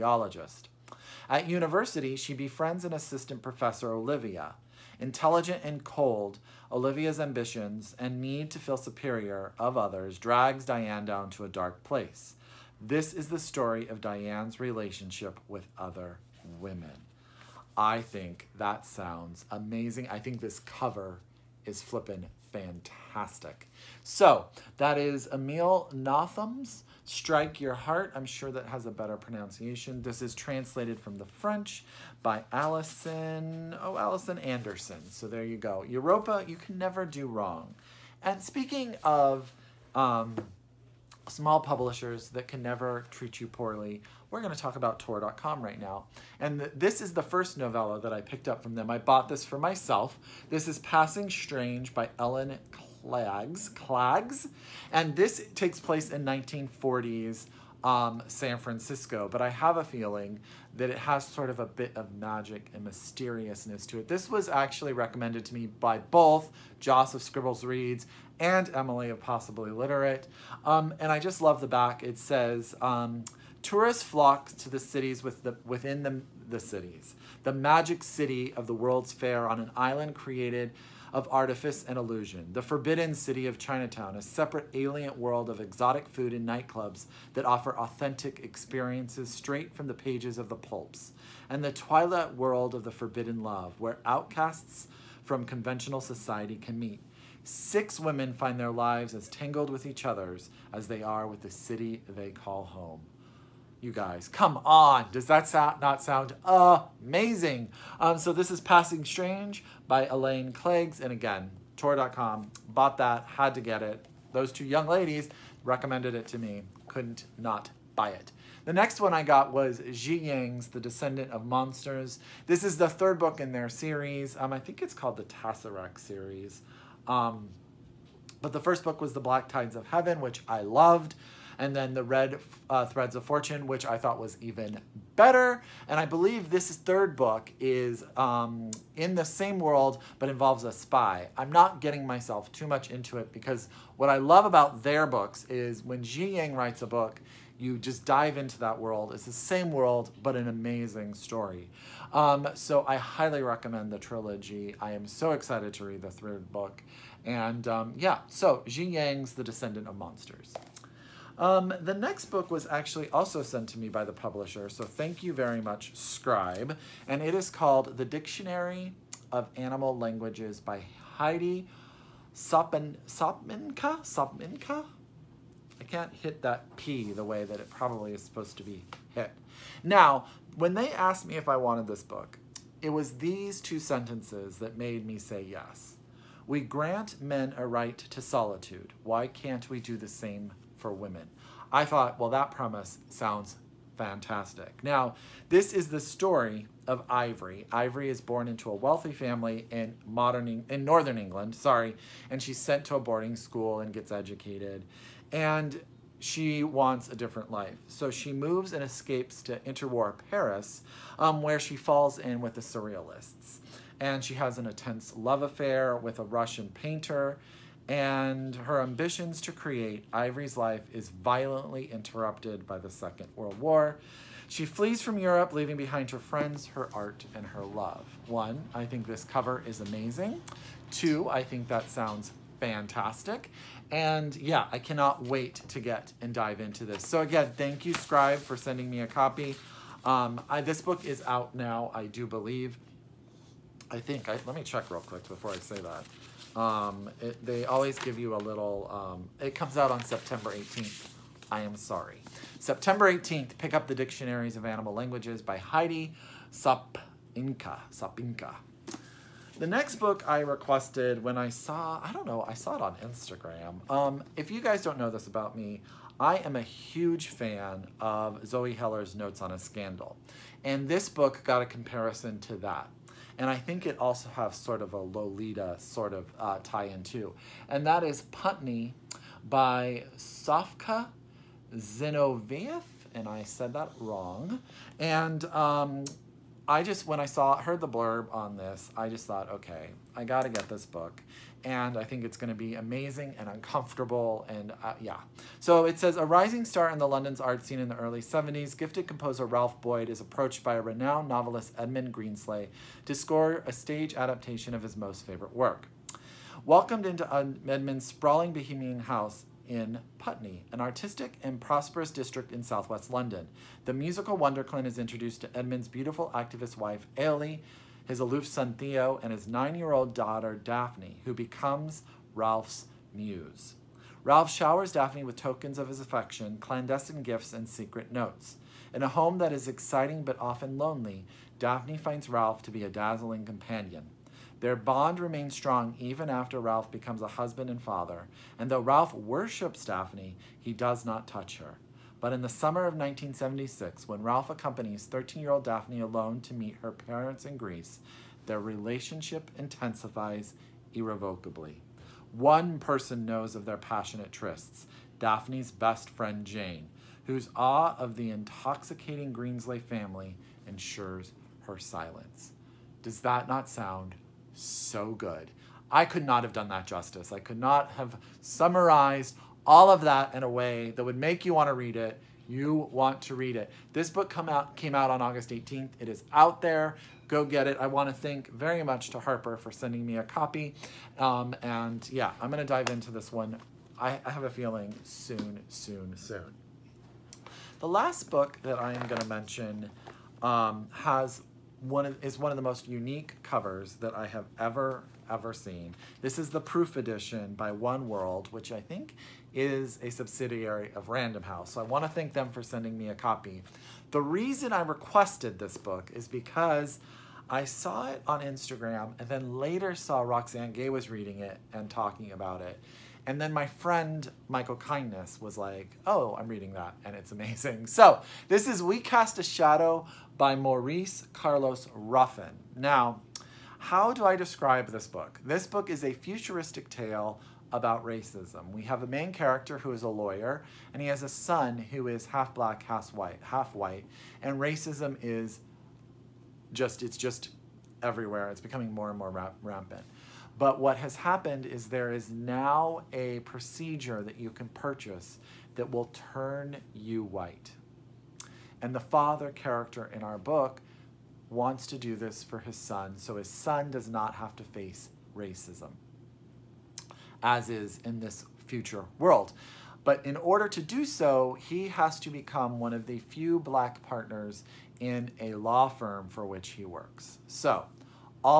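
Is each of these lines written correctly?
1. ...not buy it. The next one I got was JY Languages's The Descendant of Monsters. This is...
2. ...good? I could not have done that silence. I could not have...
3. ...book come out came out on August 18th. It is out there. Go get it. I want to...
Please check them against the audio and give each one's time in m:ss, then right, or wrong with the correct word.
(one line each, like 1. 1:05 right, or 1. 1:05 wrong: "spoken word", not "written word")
1. 1:57 wrong: "Yang", not "Languages"
2. 6:05 wrong: "justice", not "silence"
3. 6:14 right.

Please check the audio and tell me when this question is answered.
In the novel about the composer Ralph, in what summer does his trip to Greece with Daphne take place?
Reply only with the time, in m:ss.
5:42.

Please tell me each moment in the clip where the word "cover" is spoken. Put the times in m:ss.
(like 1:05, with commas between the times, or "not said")
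0:20, 3:49, 6:33.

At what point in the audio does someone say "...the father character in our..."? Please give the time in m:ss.
7:28.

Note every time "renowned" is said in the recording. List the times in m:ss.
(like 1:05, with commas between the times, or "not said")
5:00.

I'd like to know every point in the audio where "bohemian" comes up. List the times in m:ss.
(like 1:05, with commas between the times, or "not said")
5:08.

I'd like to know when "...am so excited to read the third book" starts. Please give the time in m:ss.
2:34.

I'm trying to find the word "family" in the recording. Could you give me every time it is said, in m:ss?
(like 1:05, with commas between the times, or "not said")
3:19, 5:59.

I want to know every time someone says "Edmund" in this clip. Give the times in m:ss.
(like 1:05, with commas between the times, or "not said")
5:01, 5:07, 5:15.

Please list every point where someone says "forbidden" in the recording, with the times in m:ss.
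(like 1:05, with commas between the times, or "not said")
1:22, 1:32.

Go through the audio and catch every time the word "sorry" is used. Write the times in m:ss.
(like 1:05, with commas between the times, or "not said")
3:21, 4:11.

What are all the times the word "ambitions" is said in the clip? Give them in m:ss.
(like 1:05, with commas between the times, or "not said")
0:07, 3:38.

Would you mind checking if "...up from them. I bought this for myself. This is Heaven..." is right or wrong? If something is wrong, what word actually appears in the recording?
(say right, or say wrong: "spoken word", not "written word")
wrong: "Passing", not "Heaven".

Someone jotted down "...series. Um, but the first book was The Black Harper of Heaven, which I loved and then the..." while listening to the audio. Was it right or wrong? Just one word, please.
wrong.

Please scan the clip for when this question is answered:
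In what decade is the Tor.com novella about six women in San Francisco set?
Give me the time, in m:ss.
0:56.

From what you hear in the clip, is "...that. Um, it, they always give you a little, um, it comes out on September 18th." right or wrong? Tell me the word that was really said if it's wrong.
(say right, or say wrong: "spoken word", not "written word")
right.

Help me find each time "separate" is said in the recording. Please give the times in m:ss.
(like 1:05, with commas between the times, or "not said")
1:24.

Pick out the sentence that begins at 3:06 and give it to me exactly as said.
We grant men a right to solitude.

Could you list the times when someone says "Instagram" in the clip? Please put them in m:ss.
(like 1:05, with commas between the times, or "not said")
4:22, 6:48.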